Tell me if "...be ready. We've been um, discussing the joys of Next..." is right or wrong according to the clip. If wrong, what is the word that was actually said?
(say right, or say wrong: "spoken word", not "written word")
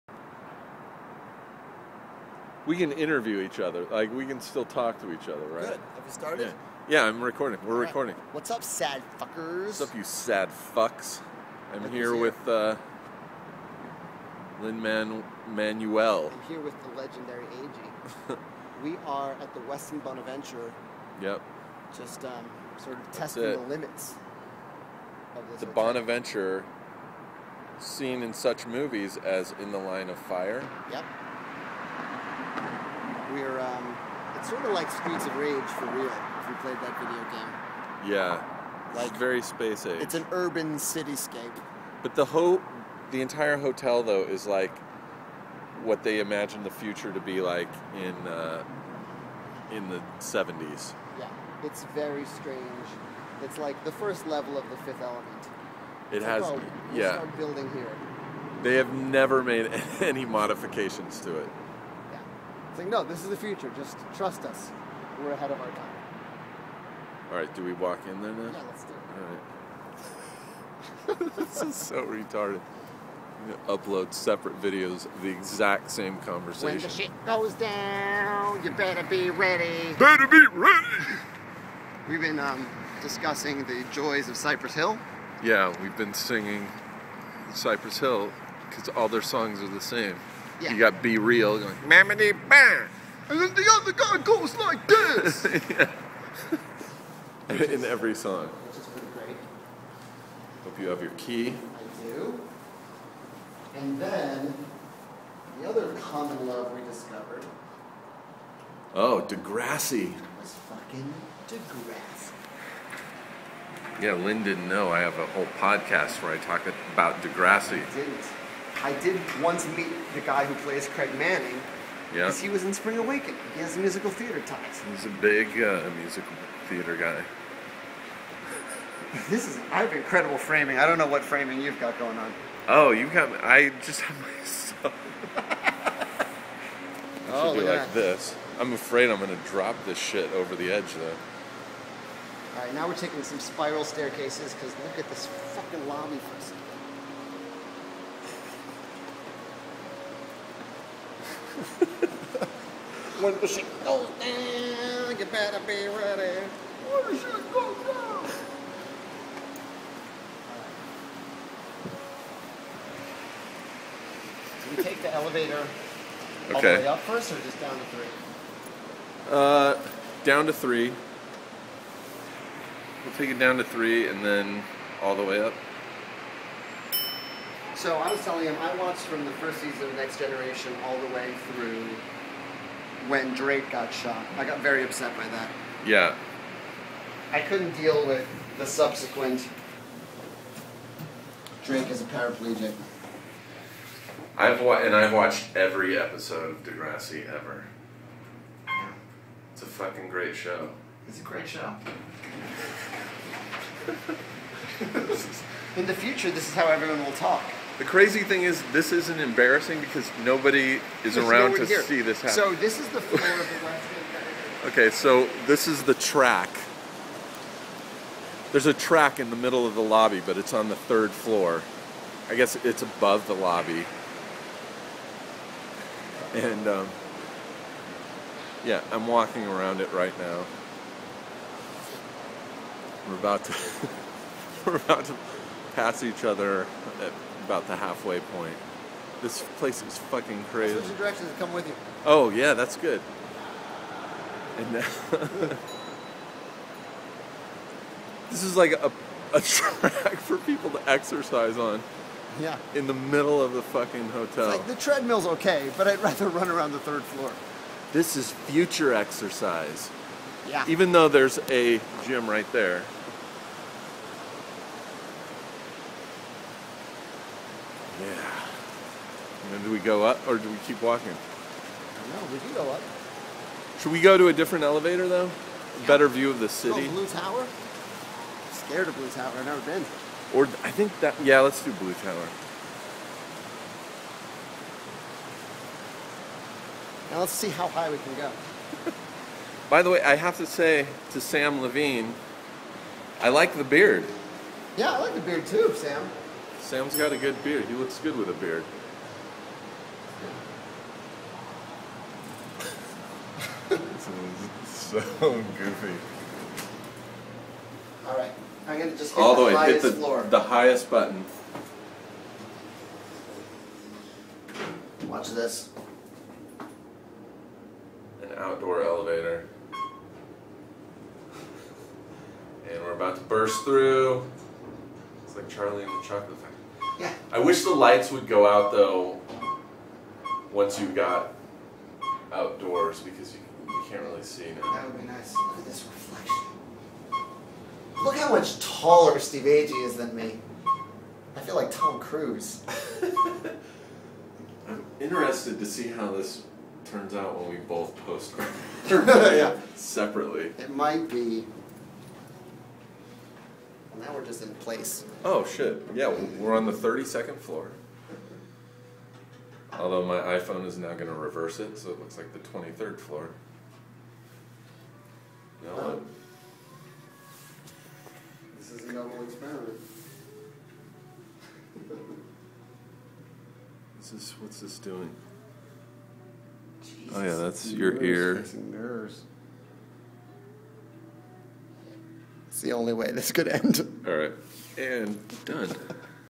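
wrong: "Cypress", not "Next".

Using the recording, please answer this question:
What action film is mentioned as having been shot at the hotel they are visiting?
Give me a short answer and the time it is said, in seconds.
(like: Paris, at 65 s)
In the Line of Fire, at 29 s.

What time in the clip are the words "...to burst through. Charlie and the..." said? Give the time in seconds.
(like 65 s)
323 s.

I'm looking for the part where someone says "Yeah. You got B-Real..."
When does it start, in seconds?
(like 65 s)
90 s.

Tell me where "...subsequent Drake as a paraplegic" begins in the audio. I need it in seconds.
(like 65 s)
188 s.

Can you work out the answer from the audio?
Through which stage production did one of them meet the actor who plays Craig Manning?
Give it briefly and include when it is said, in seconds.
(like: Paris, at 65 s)
Spring Awakening, at 122 s.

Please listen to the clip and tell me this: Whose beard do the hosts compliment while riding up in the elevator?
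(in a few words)
Sam Levine.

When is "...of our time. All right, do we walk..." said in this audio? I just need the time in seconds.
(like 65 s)
65 s.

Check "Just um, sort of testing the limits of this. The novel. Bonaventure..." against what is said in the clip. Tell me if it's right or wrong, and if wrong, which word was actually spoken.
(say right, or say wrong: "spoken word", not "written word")
wrong: "hotel", not "novel".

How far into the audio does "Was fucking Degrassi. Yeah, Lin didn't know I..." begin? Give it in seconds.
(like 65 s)
110 s.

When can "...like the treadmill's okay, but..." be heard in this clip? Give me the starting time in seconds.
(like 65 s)
254 s.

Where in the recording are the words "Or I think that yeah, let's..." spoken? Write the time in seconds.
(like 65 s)
280 s.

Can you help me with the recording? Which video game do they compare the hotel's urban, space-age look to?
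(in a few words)
Streets of Rage.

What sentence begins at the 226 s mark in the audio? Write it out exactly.
And um, yeah, I'm walking around it right now.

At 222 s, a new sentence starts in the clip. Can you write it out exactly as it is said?
I guess it's above the lobby.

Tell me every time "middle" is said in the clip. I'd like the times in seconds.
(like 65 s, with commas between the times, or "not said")
219 s, 252 s.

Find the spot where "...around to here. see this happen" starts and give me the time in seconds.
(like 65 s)
211 s.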